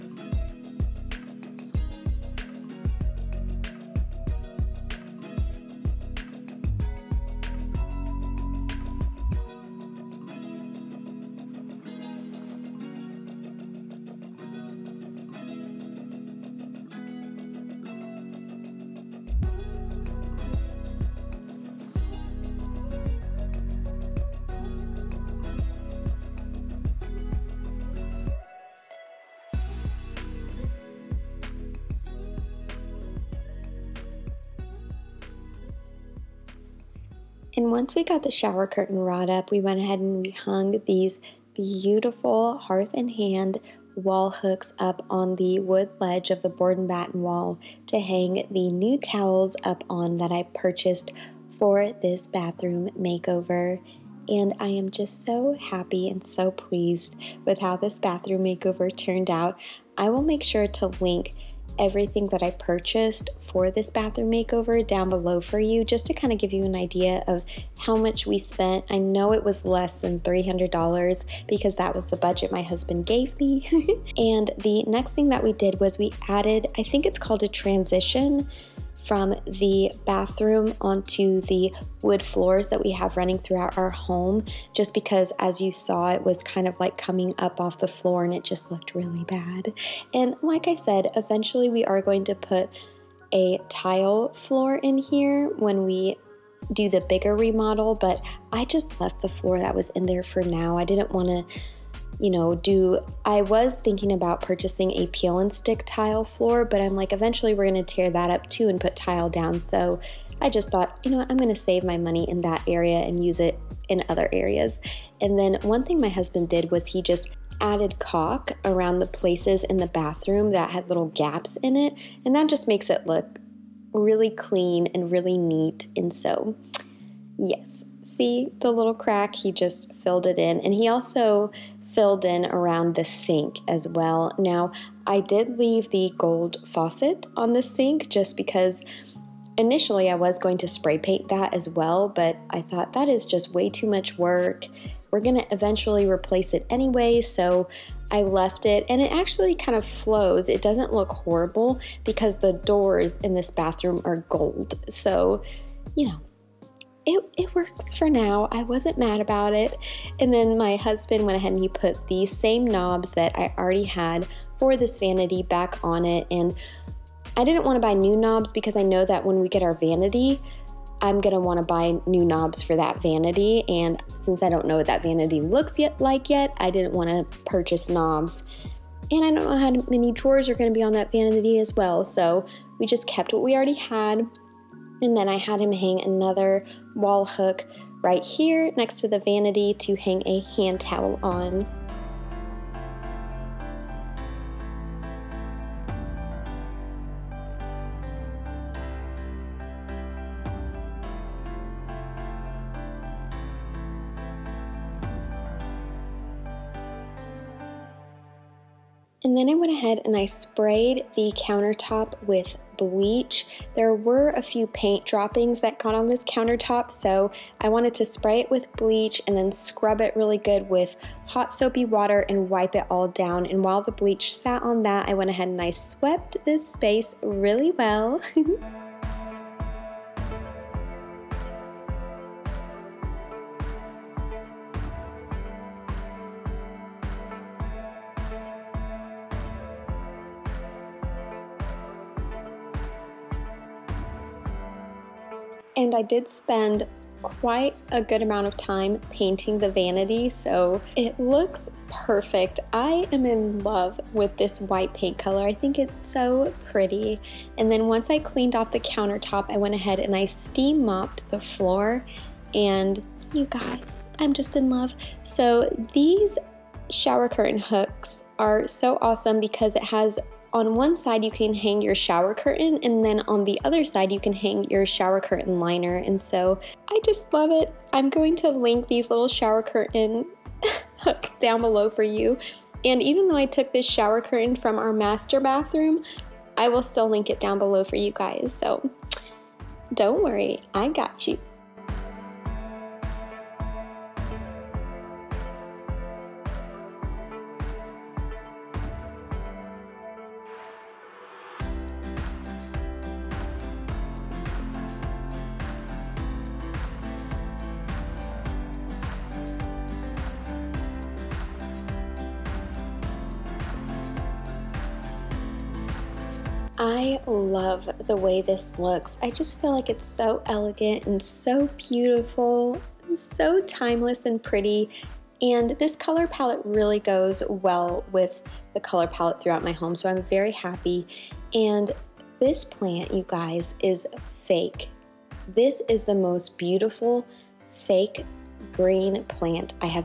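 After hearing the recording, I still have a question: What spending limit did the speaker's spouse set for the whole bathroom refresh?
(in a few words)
$300.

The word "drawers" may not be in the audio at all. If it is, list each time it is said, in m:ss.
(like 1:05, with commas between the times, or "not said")
3:00.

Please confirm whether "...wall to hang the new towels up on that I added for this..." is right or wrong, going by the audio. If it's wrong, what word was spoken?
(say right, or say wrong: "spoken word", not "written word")
wrong: "purchased", not "added".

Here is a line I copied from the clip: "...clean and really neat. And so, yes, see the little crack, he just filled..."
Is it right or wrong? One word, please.
right.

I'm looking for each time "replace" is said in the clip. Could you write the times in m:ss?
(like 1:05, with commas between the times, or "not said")
2:26.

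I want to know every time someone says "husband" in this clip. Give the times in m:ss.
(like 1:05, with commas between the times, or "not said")
1:12, 1:56, 2:40.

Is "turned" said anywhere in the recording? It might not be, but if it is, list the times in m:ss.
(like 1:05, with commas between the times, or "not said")
0:58.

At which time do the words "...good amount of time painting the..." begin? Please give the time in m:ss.
4:08.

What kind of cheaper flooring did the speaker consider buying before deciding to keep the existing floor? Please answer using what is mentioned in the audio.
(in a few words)
peel and stick tile.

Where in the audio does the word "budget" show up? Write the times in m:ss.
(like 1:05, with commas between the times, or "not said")
1:12.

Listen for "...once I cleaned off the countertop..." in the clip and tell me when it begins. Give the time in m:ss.
4:17.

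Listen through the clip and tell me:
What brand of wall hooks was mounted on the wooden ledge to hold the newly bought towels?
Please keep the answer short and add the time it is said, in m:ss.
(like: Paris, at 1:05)
Hearth and Hand, at 0:42.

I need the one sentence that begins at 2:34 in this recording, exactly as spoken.
So, you know, it, it works for now.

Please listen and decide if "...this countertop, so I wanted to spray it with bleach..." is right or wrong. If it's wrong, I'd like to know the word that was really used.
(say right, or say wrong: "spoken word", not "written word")
right.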